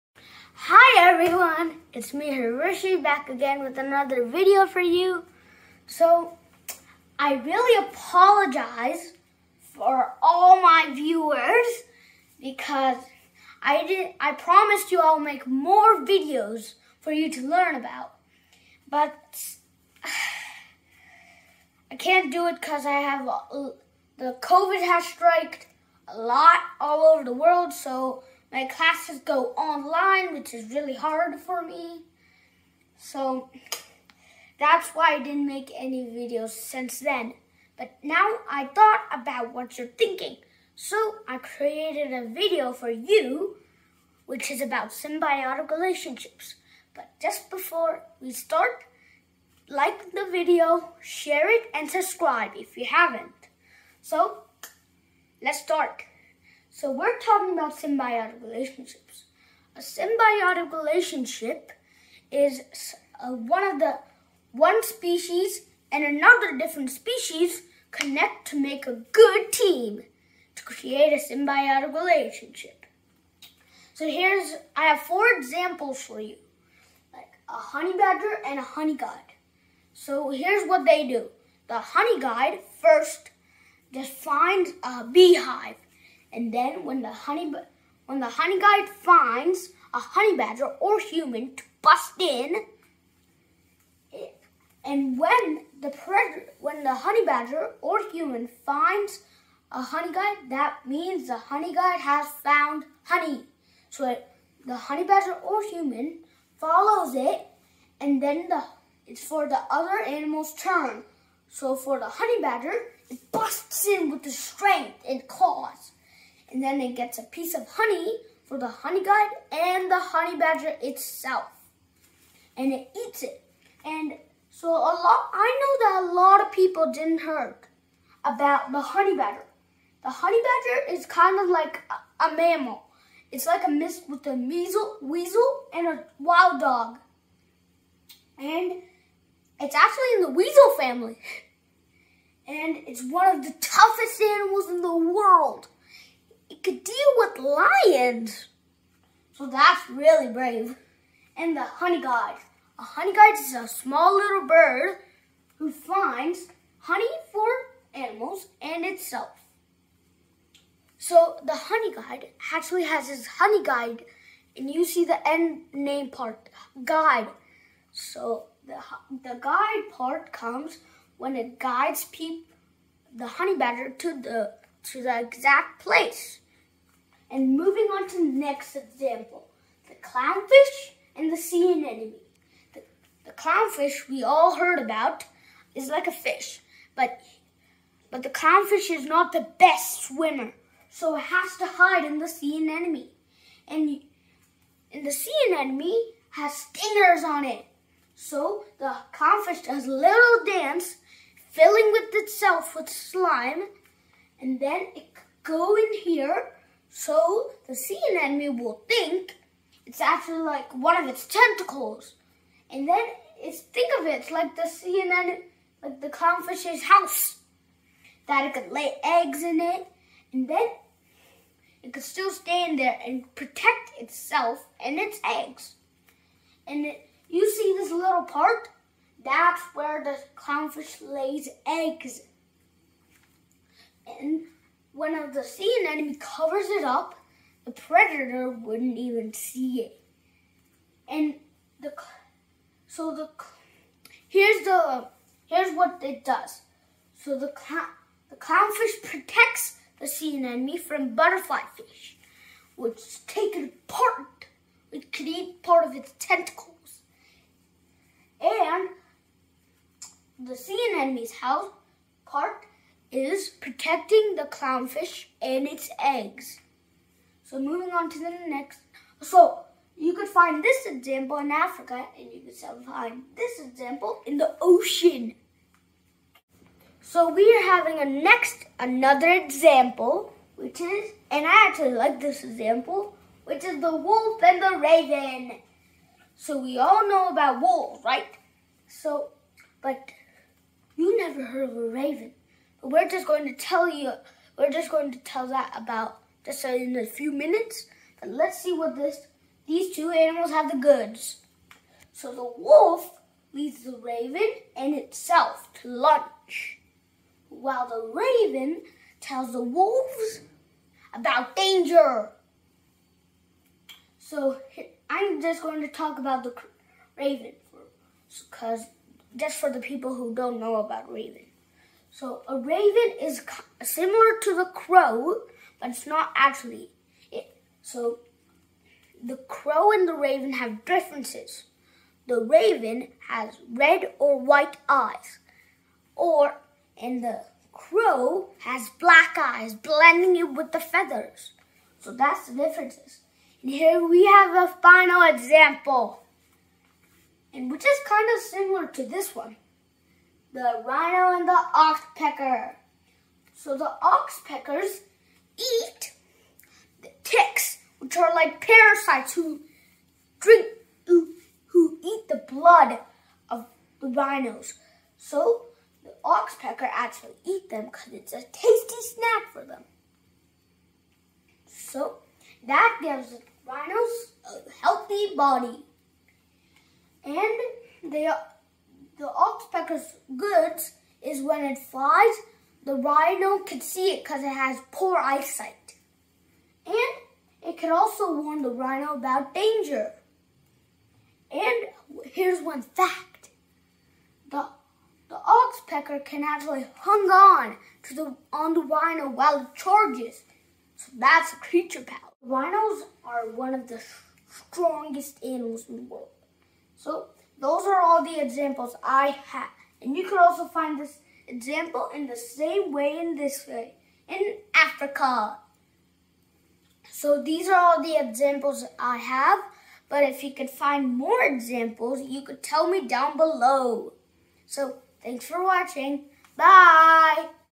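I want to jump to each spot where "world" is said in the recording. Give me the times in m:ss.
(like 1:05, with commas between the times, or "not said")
0:27, 2:24, 6:46.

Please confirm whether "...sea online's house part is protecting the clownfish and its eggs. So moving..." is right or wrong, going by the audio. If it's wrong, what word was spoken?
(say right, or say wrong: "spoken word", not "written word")
wrong: "anemone", not "online".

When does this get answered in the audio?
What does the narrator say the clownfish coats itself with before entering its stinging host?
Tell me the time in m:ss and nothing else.
3:22.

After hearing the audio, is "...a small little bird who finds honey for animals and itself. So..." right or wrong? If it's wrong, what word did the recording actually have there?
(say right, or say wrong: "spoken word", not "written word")
right.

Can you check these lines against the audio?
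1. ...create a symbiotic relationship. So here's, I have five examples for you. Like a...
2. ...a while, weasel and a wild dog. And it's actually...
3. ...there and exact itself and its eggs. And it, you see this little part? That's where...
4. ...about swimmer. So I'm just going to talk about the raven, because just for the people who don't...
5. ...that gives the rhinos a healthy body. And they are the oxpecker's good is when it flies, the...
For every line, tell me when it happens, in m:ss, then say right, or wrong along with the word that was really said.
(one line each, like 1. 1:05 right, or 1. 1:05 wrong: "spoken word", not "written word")
1. 1:10 wrong: "four", not "five"
2. 2:14 wrong: "measle", not "while"
3. 3:42 wrong: "protect", not "exact"
4. 5:11 wrong: "danger", not "swimmer"
5. 6:12 right.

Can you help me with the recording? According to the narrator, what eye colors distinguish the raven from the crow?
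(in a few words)
Red or white.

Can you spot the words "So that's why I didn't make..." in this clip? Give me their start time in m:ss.
0:32.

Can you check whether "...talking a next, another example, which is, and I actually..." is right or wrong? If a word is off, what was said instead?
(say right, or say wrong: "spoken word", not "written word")
wrong: "having", not "talking".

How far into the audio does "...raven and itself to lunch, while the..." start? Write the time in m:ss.
5:03.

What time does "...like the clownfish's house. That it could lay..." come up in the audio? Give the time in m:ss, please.
3:35.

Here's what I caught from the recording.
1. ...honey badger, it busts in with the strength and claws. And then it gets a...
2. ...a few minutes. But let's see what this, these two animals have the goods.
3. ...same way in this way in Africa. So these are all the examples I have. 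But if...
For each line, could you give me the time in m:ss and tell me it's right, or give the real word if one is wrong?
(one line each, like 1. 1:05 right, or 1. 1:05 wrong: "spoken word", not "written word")
1. 1:52 right
2. 4:56 right
3. 6:52 right.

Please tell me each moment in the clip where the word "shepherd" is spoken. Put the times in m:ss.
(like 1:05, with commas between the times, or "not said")
not said.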